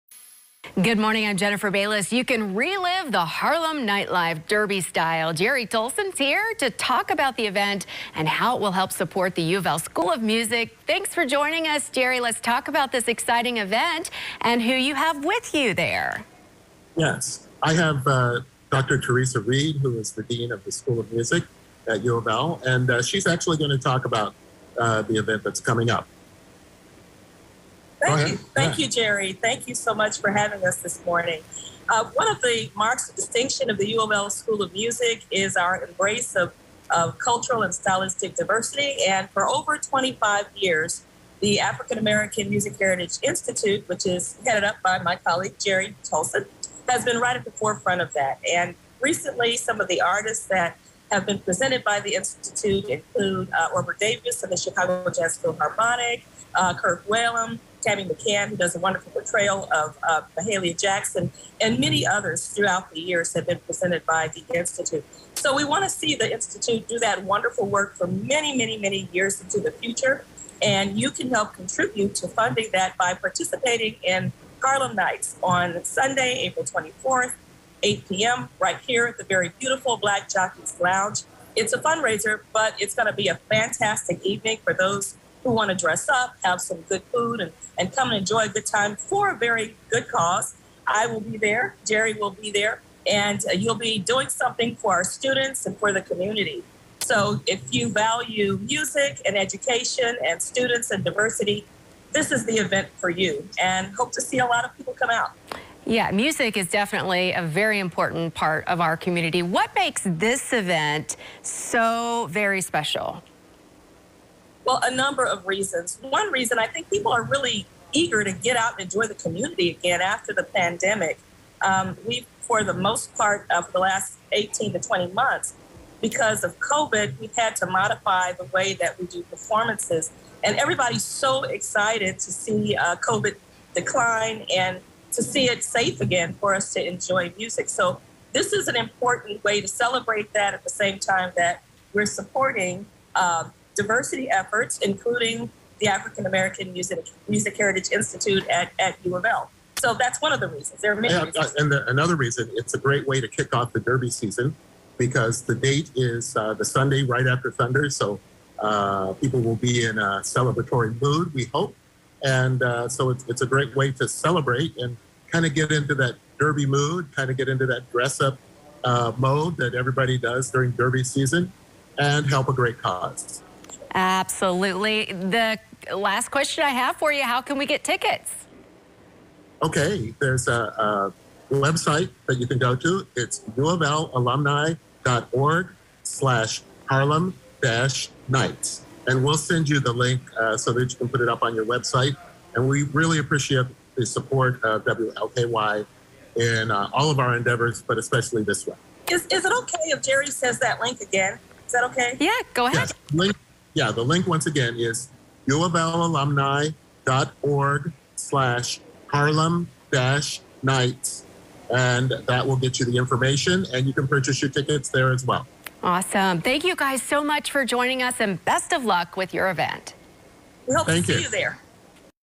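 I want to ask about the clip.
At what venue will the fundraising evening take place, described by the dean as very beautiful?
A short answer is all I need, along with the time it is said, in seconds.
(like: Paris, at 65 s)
Black Jockeys Lounge, at 79 s.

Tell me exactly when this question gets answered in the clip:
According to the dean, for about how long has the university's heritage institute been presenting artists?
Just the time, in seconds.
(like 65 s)
39 s.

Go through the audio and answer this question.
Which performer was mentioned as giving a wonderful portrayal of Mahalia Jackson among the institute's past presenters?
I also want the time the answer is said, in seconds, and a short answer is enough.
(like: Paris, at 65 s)
Tammy McCann, at 57 s.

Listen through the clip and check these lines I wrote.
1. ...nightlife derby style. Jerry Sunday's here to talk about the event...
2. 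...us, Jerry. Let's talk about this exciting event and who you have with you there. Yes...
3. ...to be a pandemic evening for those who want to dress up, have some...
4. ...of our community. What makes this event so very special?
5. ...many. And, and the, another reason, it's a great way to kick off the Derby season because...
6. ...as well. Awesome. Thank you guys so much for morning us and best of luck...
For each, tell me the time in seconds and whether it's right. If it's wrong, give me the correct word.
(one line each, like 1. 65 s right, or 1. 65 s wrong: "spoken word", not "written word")
1. 3 s wrong: "Tolson", not "Sunday"
2. 11 s right
3. 83 s wrong: "fantastic", not "pandemic"
4. 108 s right
5. 150 s right
6. 215 s wrong: "joining", not "morning".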